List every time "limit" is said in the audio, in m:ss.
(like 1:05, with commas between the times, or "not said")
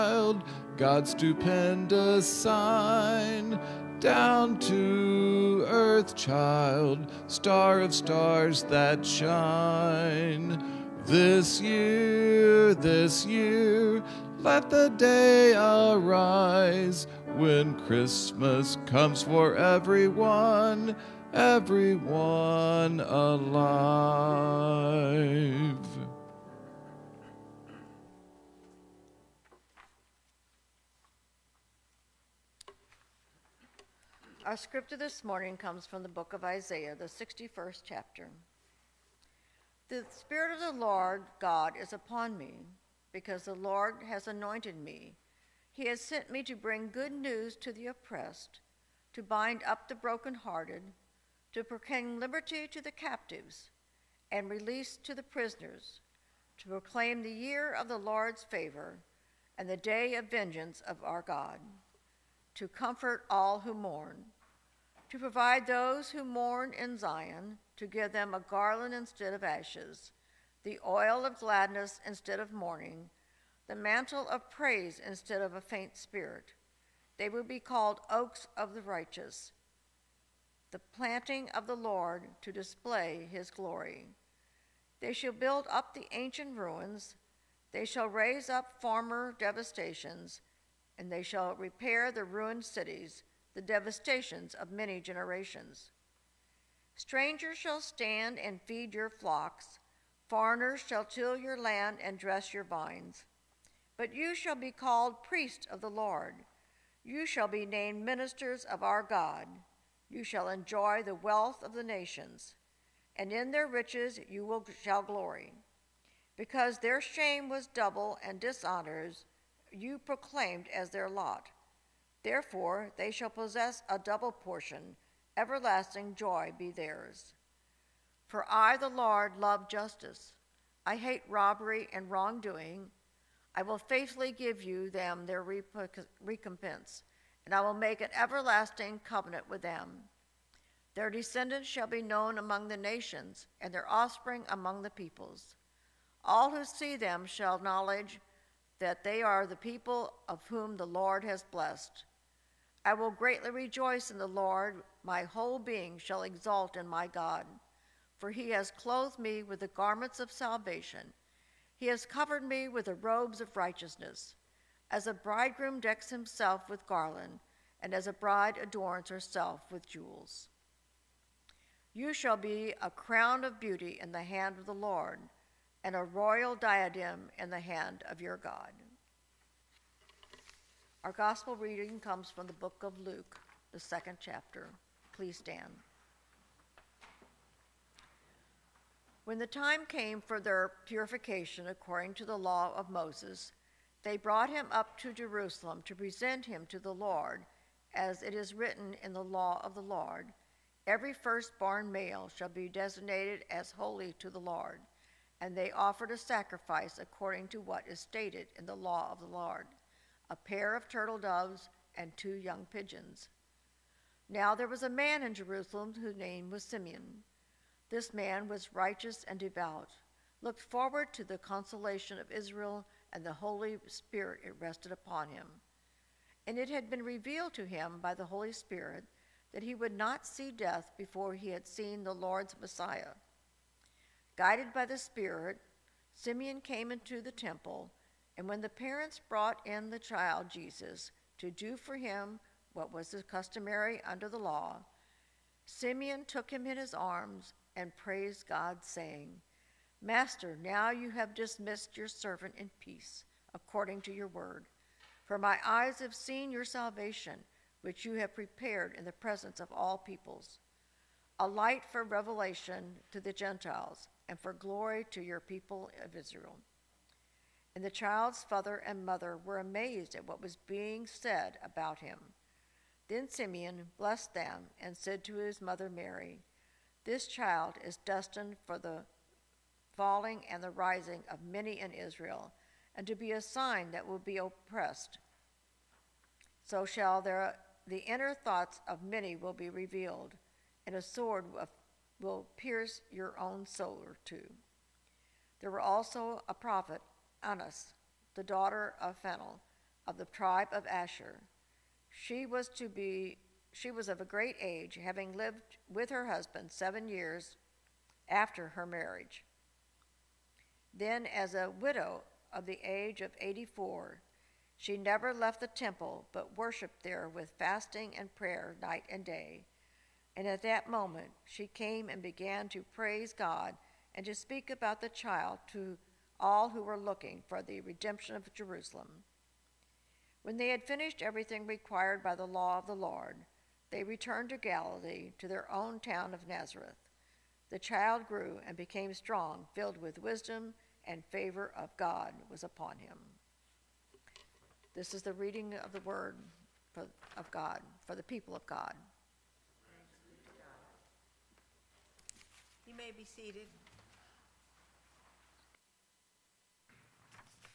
not said.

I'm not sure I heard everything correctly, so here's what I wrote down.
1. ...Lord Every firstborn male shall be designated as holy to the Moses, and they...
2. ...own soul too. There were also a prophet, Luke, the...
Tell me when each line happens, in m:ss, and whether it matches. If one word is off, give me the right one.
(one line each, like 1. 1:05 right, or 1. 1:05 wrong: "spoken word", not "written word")
1. 3:19 wrong: "Lord", not "Moses"
2. 4:53 wrong: "Annas", not "Luke".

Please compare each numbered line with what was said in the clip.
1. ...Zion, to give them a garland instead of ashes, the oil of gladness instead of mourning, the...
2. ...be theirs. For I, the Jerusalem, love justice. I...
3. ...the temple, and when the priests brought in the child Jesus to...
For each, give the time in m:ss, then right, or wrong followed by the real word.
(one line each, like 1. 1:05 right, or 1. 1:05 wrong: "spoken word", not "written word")
1. 1:06 right
2. 2:06 wrong: "Lord", not "Jerusalem"
3. 3:57 wrong: "parents", not "priests".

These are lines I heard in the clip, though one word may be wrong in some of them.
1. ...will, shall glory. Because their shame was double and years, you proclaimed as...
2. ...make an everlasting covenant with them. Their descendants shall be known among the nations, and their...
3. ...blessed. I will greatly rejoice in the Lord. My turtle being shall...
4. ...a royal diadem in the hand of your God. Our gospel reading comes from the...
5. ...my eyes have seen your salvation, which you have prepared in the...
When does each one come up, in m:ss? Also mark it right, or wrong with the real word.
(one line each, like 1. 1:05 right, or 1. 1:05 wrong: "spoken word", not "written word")
1. 1:54 wrong: "dishonors", not "years"
2. 2:17 right
3. 2:31 wrong: "whole", not "turtle"
4. 2:55 right
5. 4:15 right.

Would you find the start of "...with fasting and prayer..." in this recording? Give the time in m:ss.
5:17.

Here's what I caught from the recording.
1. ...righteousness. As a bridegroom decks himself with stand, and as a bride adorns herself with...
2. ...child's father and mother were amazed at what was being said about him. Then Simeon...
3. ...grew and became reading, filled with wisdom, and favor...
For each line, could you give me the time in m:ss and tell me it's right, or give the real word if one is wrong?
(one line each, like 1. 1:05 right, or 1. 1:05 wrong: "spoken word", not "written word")
1. 2:43 wrong: "garland", not "stand"
2. 4:27 right
3. 5:38 wrong: "strong", not "reading".